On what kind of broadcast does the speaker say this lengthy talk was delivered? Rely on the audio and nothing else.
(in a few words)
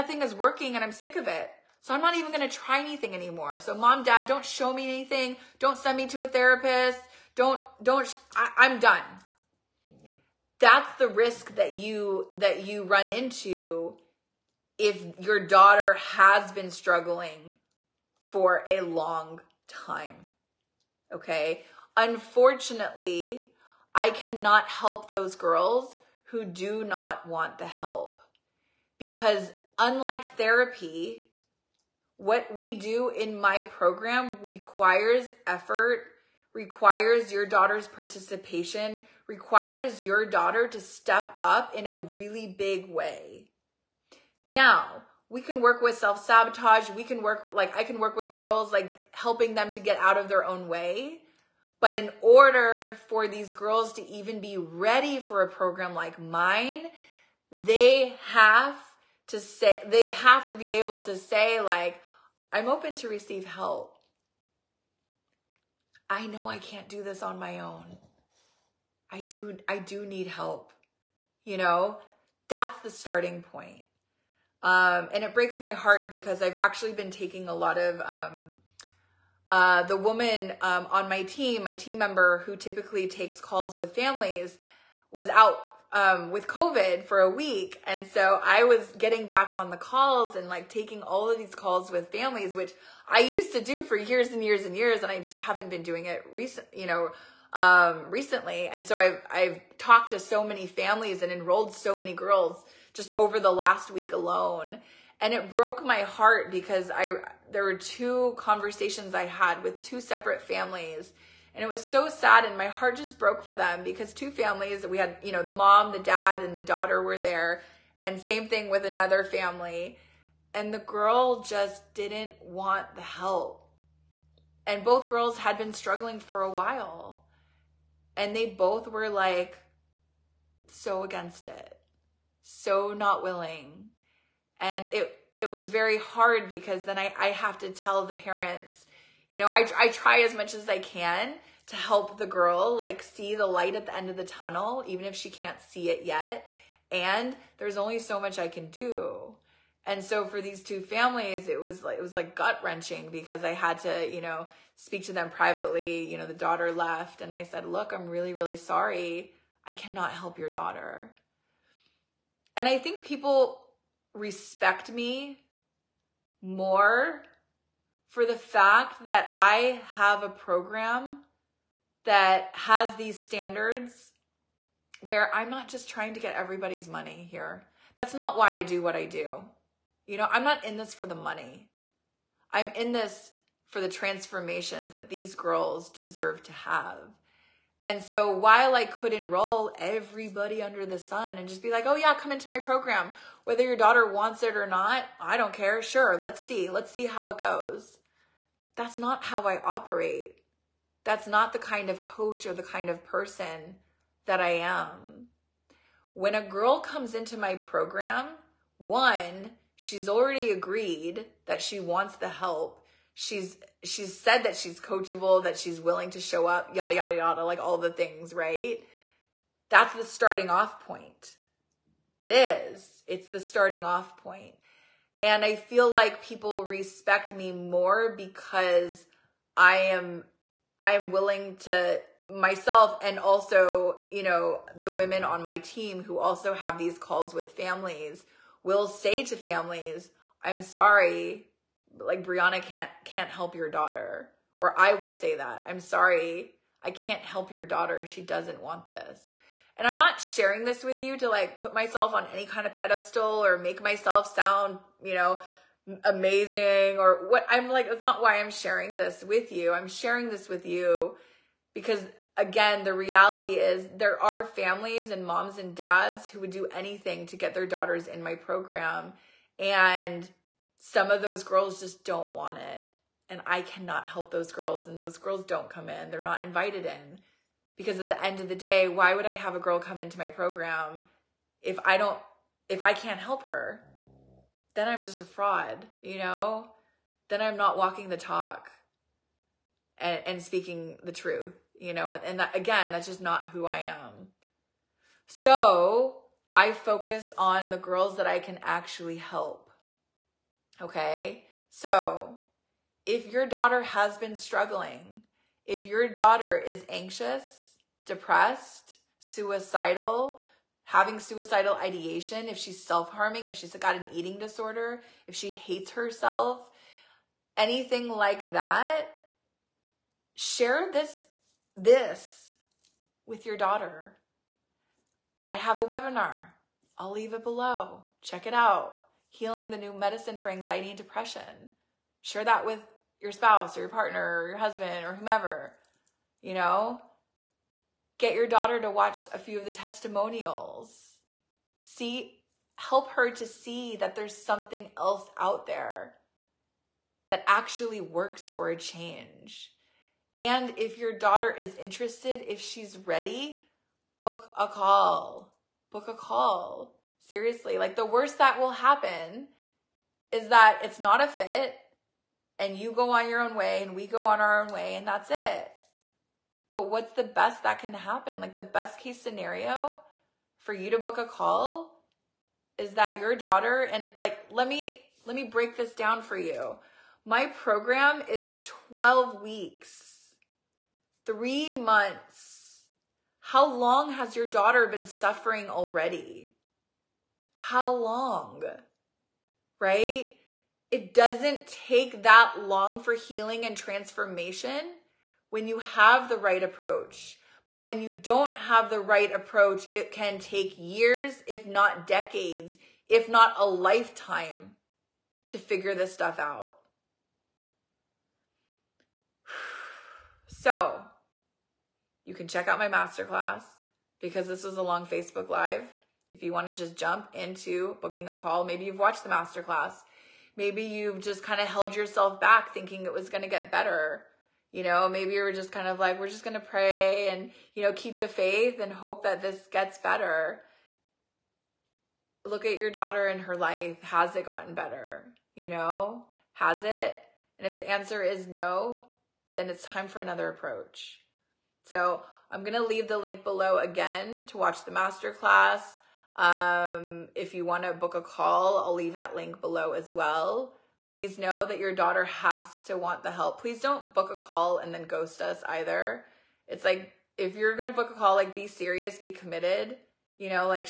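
Facebook Live.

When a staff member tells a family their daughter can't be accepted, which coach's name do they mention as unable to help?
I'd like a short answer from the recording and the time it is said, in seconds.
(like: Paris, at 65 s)
Breanna, at 242 s.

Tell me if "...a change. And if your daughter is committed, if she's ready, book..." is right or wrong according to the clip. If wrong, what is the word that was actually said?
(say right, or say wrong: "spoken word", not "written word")
wrong: "interested", not "committed".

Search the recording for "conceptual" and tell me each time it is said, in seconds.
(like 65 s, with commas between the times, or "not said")
not said.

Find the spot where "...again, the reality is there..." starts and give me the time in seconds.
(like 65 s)
262 s.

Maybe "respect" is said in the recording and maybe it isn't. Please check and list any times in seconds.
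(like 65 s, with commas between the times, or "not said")
164 s, 226 s.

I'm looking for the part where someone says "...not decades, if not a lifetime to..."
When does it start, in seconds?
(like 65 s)
401 s.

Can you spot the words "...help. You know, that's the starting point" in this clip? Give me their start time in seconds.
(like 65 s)
70 s.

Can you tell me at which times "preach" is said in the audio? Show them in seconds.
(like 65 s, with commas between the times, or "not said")
not said.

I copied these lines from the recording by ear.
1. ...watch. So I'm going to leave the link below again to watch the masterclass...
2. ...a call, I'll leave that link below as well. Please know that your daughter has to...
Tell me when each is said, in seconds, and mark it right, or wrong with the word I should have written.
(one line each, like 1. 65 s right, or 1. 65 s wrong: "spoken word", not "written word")
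1. 440 s wrong: "approach", not "watch"
2. 448 s right.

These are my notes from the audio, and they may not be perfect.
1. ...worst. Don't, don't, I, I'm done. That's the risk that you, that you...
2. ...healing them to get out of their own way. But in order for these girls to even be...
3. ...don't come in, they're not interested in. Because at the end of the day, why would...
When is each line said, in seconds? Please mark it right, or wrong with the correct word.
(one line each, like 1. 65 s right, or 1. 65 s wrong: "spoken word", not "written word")
1. 6 s wrong: "therapist", not "worst"
2. 49 s wrong: "helping", not "healing"
3. 275 s wrong: "invited", not "interested".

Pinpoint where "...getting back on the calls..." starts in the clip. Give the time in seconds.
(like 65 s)
88 s.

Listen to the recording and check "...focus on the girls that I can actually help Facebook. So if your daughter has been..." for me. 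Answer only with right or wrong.
wrong.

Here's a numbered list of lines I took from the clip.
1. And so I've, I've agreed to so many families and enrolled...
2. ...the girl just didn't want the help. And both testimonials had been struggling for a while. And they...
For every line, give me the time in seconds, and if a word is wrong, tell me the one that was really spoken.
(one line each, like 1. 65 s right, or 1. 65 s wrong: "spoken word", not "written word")
1. 98 s wrong: "talked", not "agreed"
2. 120 s wrong: "girls", not "testimonials".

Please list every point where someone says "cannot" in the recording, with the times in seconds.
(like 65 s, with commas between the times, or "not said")
24 s, 159 s, 273 s.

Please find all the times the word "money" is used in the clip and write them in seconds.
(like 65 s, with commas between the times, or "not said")
176 s, 181 s.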